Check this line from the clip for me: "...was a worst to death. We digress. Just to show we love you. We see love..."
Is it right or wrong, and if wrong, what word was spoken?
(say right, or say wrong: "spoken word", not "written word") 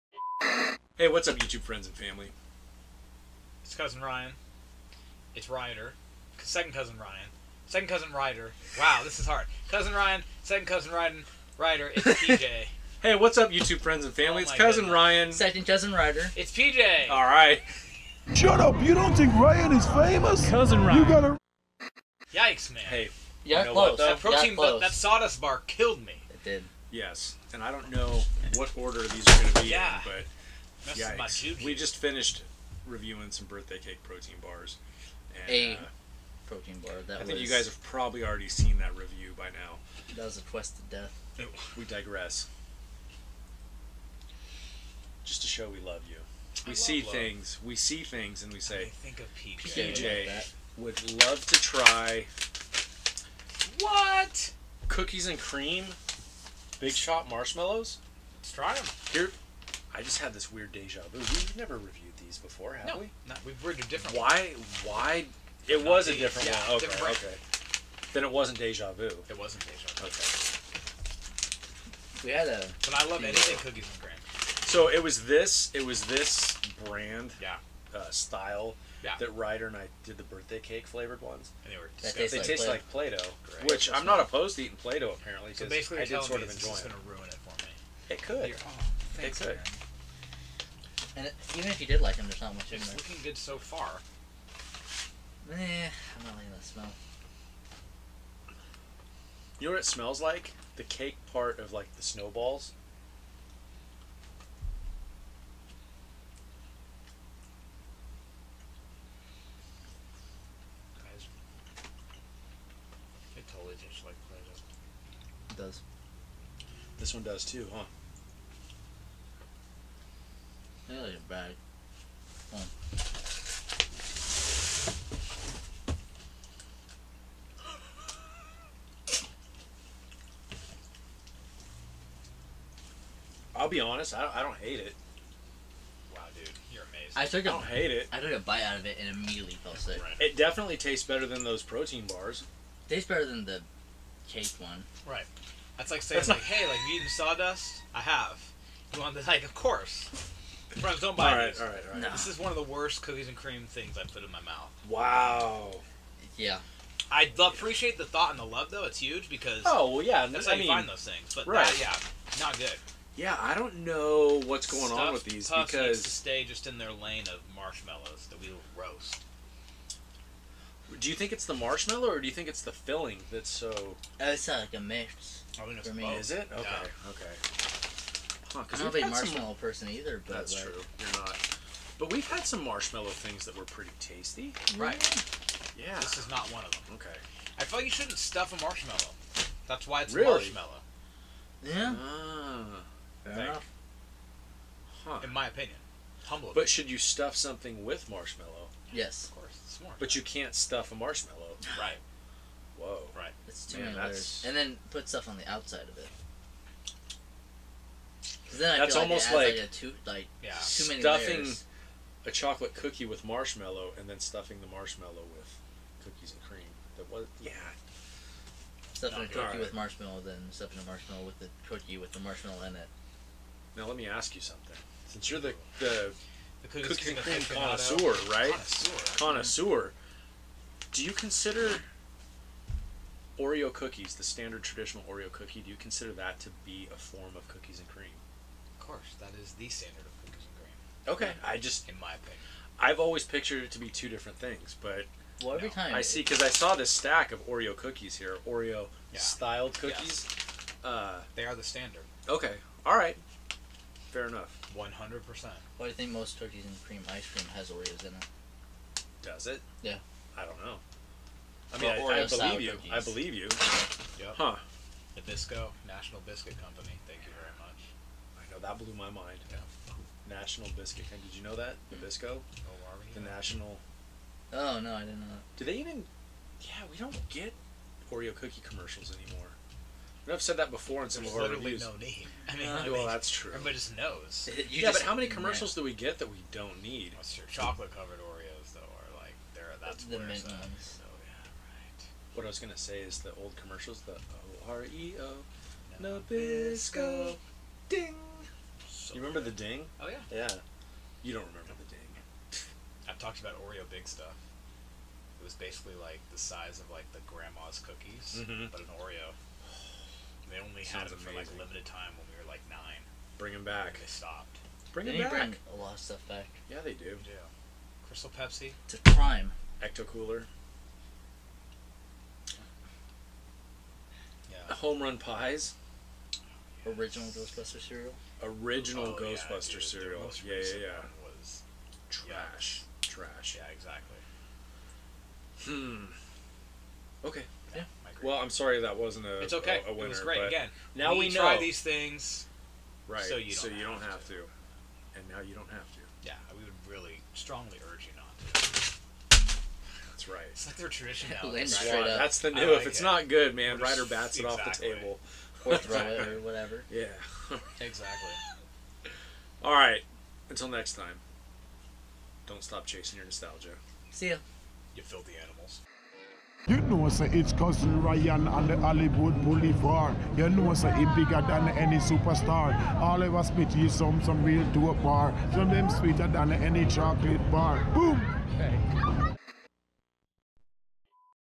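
wrong: "quest", not "worst".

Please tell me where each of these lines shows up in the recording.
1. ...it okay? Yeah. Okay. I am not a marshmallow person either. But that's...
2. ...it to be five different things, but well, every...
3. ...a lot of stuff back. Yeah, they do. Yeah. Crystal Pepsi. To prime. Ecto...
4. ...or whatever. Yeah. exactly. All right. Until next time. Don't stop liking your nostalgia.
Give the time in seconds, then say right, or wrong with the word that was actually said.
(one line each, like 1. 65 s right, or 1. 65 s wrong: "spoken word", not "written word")
1. 176 s right
2. 243 s wrong: "two", not "five"
3. 315 s right
4. 356 s wrong: "chasing", not "liking".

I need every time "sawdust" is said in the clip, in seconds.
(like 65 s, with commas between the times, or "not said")
24 s, 147 s.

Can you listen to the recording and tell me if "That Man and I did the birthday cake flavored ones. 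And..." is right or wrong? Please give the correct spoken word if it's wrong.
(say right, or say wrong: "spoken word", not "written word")
wrong: "Ryder", not "Man".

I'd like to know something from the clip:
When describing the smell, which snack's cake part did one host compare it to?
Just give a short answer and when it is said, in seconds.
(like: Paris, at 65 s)
Snowballs, at 102 s.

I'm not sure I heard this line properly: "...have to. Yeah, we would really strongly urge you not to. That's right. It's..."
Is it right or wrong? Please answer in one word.
right.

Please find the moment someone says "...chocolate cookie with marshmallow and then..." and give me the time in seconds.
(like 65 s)
212 s.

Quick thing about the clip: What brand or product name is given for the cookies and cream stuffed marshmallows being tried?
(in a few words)
Big Shot.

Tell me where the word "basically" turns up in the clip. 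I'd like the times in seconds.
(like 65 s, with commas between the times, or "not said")
85 s, 305 s.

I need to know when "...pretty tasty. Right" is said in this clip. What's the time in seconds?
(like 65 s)
183 s.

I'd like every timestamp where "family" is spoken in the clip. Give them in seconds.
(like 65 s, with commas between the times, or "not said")
1 s, 14 s.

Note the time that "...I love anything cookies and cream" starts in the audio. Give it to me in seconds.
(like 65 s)
73 s.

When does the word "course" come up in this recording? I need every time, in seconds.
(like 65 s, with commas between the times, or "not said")
149 s, 199 s.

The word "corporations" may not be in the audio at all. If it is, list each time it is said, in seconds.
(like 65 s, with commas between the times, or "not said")
not said.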